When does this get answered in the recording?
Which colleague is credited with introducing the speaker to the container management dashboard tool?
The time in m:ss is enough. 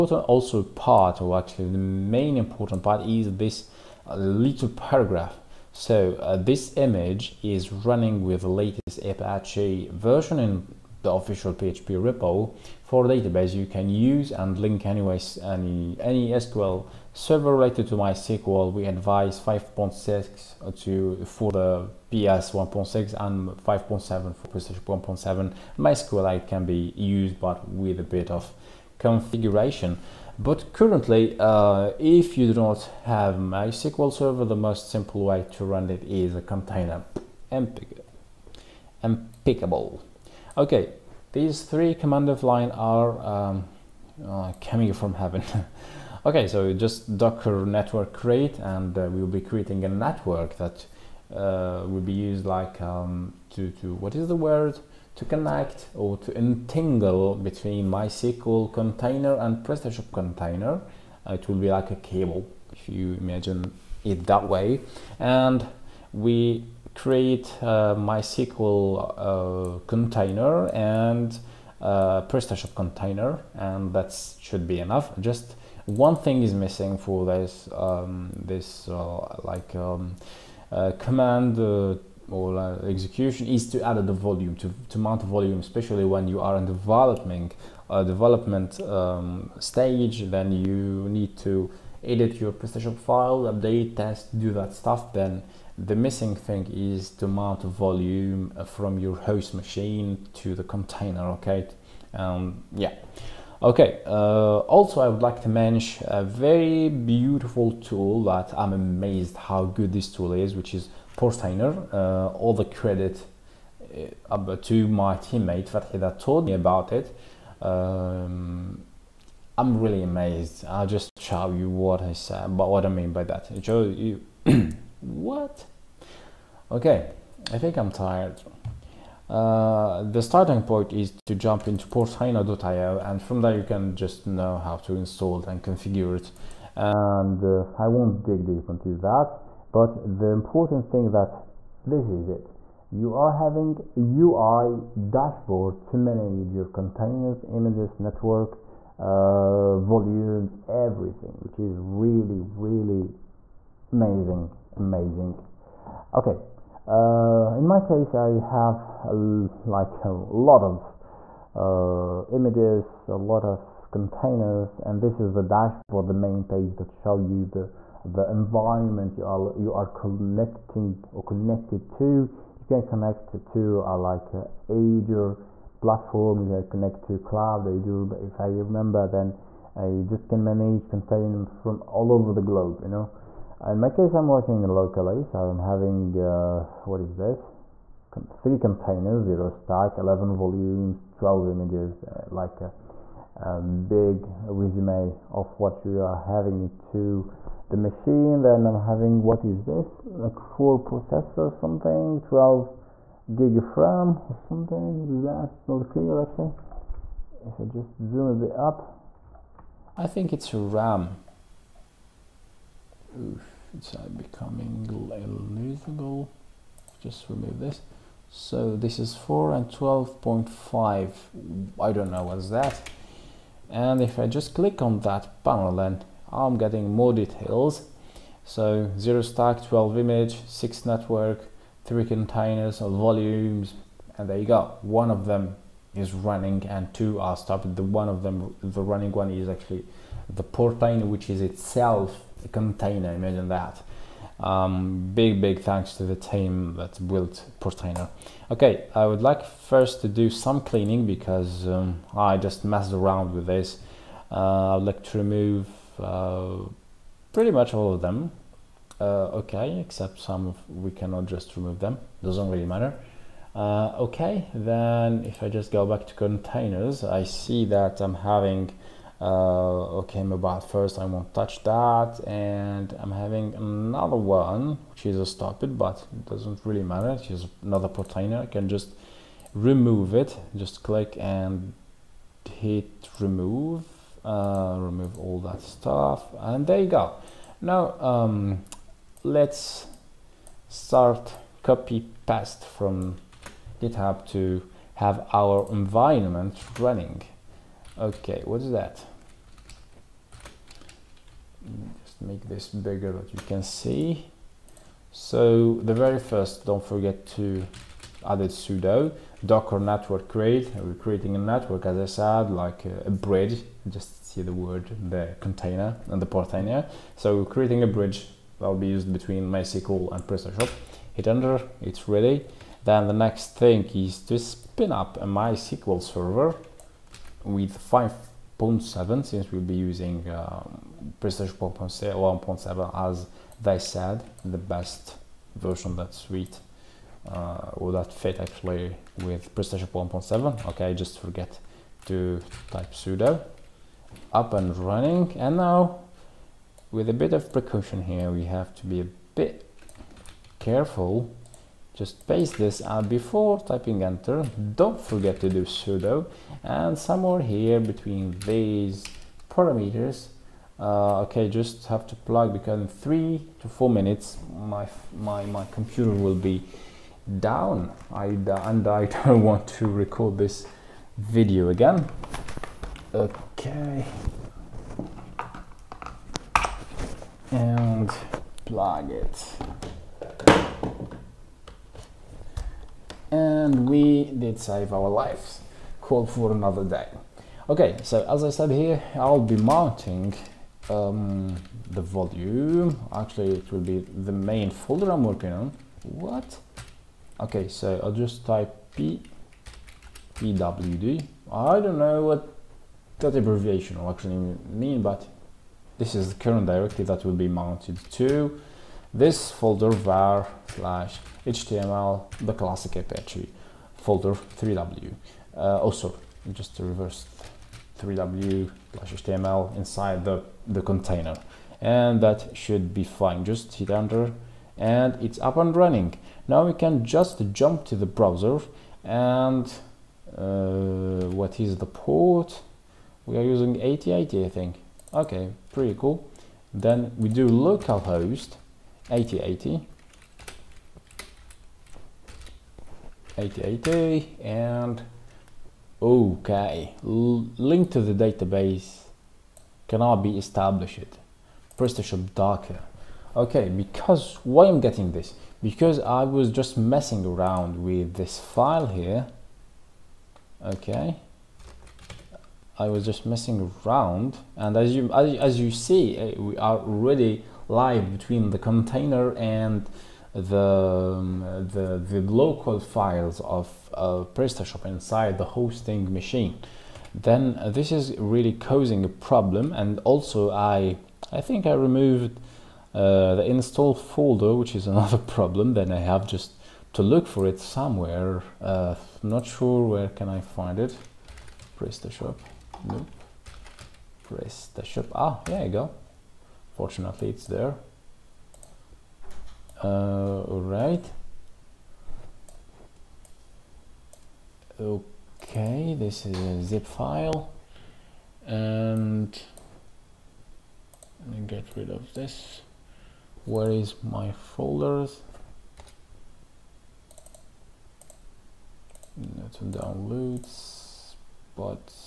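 1:55.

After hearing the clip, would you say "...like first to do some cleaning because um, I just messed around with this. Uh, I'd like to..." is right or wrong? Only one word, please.
right.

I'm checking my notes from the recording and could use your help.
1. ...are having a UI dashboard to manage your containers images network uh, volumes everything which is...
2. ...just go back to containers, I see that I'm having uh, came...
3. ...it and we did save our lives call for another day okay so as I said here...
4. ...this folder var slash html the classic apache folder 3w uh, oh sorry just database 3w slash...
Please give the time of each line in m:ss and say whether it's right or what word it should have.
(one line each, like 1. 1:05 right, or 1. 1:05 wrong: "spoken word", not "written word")
1. 2:23 right
2. 4:25 right
3. 6:19 right
4. 6:49 wrong: "reverse", not "database".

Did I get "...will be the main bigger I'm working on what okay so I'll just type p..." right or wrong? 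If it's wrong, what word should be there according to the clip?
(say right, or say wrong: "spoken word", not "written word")
wrong: "folder", not "bigger".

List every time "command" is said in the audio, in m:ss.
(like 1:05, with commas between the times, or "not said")
0:41, 1:20.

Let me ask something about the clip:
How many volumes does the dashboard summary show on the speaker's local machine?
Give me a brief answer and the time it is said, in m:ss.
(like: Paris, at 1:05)
11, at 3:09.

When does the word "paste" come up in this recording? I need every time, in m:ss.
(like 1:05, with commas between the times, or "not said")
4:52, 5:52.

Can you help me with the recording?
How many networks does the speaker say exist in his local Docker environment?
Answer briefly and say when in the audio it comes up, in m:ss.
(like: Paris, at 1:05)
6, at 3:50.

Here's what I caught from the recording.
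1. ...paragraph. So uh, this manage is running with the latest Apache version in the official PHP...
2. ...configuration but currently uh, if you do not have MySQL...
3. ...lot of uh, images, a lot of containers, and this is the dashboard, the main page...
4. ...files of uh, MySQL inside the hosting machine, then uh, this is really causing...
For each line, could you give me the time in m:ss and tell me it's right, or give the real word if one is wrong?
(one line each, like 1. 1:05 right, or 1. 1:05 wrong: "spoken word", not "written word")
1. 0:04 wrong: "image", not "manage"
2. 0:28 right
3. 2:40 right
4. 7:52 wrong: "PrestaShop", not "MySQL".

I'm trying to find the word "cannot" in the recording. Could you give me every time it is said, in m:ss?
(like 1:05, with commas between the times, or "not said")
4:20, 7:29.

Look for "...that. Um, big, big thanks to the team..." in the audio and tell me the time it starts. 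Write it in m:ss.
4:03.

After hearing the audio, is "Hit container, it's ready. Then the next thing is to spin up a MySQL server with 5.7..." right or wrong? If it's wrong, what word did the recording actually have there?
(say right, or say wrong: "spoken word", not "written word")
wrong: "enter", not "container".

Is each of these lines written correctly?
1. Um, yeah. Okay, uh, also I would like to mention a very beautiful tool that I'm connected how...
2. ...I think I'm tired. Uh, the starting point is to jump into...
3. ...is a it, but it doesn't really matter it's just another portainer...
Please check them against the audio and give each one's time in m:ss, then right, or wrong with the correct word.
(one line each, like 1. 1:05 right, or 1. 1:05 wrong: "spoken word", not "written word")
1. 1:42 wrong: "amazed", not "connected"
2. 2:07 right
3. 4:35 right.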